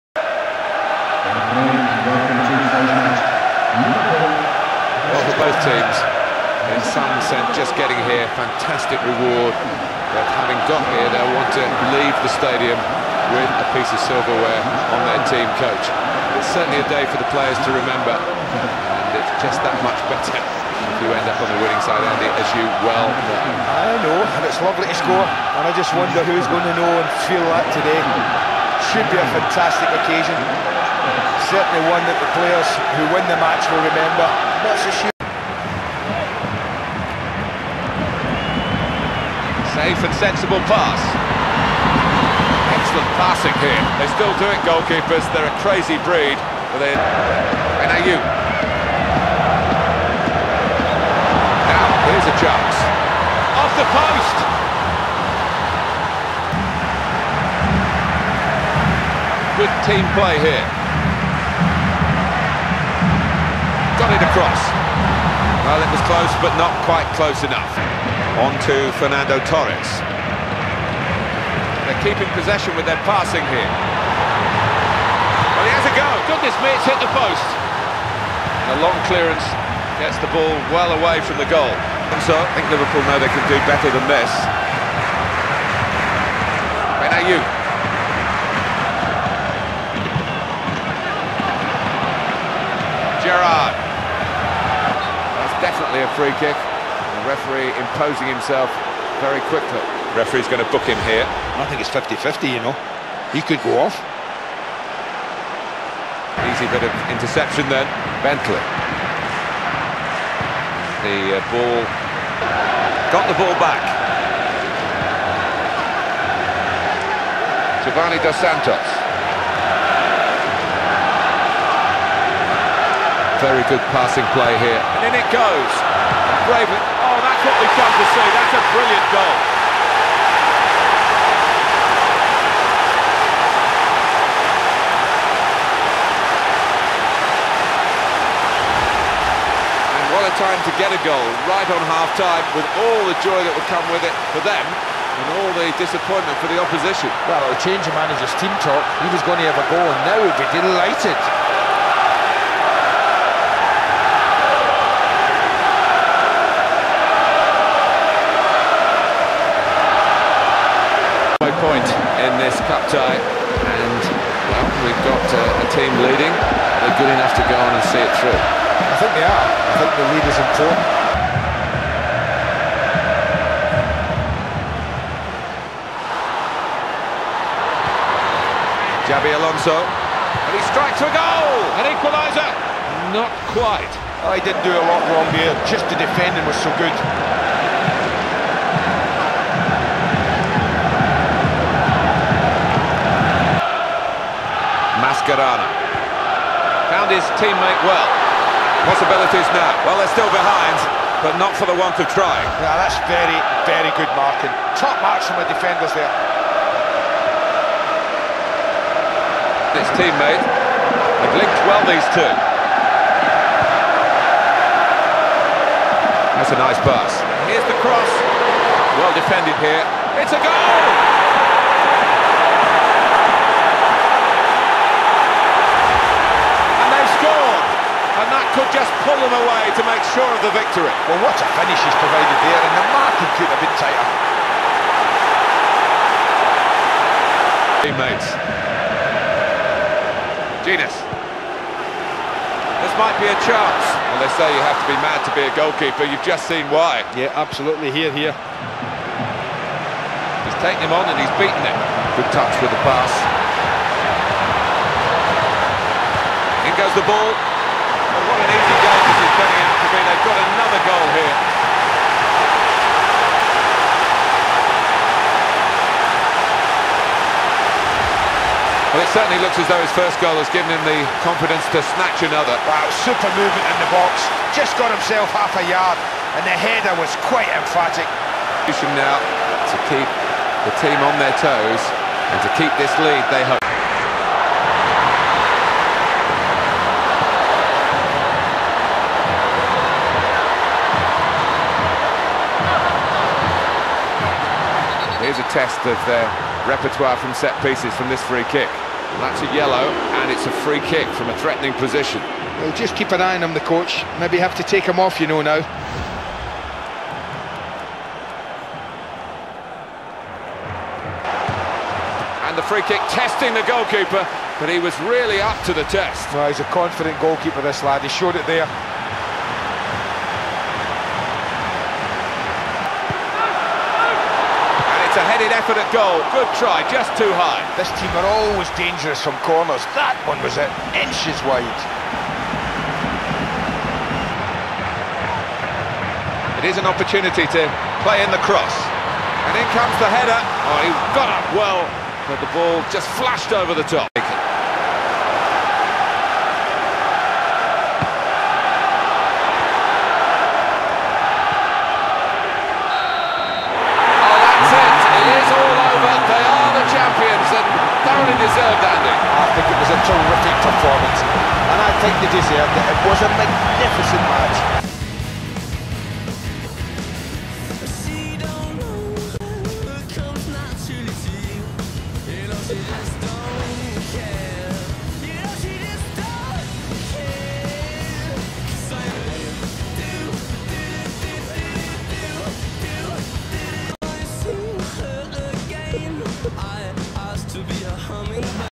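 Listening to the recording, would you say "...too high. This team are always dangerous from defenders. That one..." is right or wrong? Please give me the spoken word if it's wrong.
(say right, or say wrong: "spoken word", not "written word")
wrong: "corners", not "defenders".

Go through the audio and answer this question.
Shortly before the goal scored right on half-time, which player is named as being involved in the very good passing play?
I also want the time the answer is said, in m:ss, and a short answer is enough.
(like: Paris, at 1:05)
Giovanni Dos Santos, at 1:57.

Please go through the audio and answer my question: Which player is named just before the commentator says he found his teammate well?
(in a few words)
Mascherano.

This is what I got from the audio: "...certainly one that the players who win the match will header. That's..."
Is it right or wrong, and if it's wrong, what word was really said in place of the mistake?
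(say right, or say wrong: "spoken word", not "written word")
wrong: "remember", not "header".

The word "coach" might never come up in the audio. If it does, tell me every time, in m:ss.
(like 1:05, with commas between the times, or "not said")
0:15, 5:03.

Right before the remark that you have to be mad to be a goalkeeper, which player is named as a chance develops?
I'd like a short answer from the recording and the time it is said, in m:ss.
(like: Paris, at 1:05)
Jenas, at 4:00.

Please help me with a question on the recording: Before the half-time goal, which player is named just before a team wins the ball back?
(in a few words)
Bentley.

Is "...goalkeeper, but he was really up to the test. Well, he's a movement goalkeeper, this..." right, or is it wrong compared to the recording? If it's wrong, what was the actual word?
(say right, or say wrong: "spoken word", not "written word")
wrong: "confident", not "movement".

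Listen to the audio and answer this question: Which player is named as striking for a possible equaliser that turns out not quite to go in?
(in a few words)
Xabi Alonso.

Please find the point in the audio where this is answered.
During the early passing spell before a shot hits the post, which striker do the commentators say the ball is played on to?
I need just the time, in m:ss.
1:08.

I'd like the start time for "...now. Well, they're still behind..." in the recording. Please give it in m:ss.
3:19.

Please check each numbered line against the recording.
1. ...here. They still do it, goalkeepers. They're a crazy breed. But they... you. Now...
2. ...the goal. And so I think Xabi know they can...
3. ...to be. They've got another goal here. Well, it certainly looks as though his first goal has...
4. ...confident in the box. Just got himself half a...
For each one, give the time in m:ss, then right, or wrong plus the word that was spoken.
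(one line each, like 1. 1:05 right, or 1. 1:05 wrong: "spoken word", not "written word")
1. 0:43 right
2. 1:21 wrong: "Liverpool", not "Xabi"
3. 4:19 right
4. 4:33 wrong: "movement", not "confident".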